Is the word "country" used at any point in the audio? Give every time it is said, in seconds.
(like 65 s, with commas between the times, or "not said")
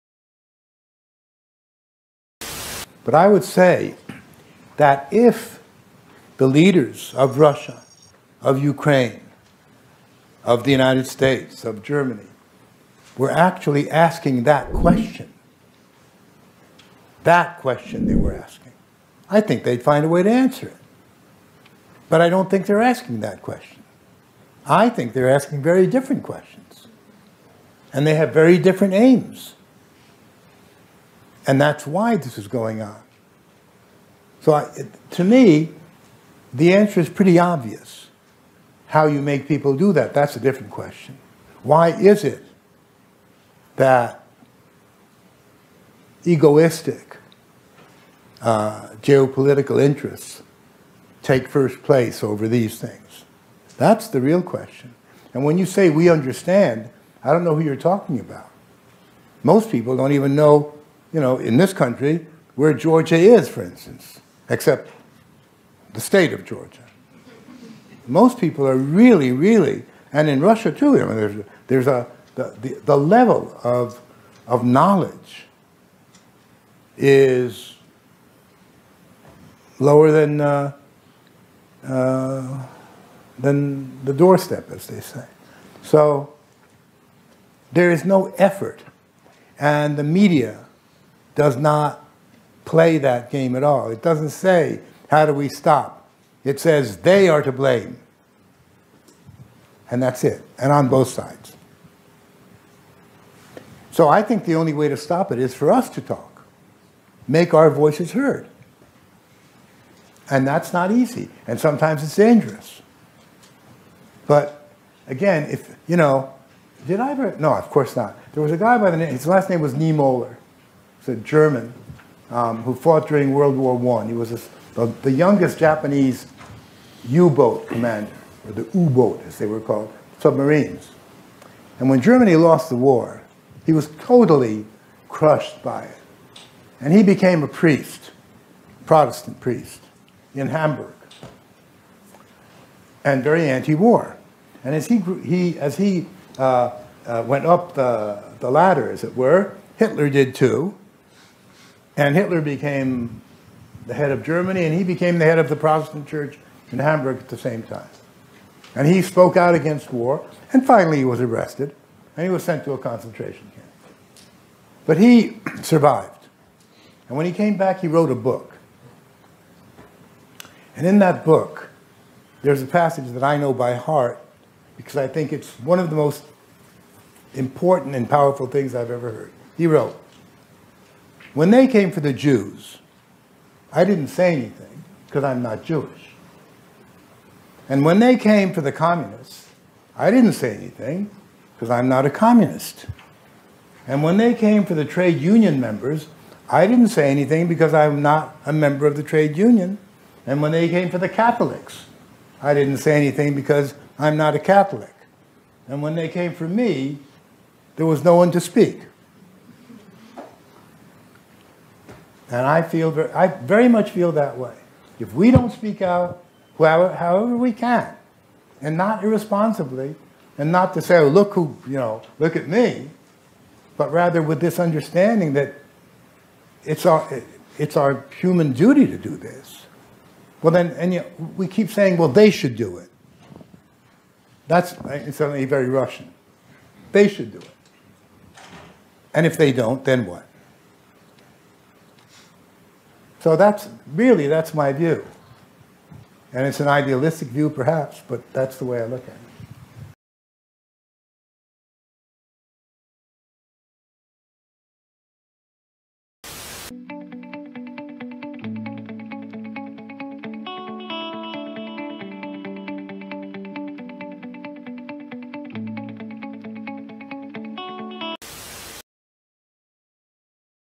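61 s.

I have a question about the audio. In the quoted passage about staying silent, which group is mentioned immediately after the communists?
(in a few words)
trade union members.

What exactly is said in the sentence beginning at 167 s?
And when he came back, he wrote a book.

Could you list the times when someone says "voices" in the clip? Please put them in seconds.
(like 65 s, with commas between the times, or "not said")
107 s.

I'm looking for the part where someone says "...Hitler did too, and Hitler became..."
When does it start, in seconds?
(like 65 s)
149 s.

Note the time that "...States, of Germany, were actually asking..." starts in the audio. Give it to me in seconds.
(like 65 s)
11 s.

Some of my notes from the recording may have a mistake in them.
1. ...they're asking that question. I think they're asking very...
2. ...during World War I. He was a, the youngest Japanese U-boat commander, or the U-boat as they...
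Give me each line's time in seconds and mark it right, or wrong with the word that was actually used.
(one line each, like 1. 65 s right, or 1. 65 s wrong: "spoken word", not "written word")
1. 22 s right
2. 123 s right.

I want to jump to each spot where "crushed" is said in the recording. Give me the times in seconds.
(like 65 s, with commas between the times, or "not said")
135 s.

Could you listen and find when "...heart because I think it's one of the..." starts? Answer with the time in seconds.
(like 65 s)
173 s.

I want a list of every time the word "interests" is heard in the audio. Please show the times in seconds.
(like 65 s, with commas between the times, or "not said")
49 s.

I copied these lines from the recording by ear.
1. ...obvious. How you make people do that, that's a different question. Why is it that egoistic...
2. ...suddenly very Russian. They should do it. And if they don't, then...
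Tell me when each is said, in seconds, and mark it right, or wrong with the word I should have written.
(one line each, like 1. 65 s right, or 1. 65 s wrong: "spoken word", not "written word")
1. 37 s right
2. 235 s right.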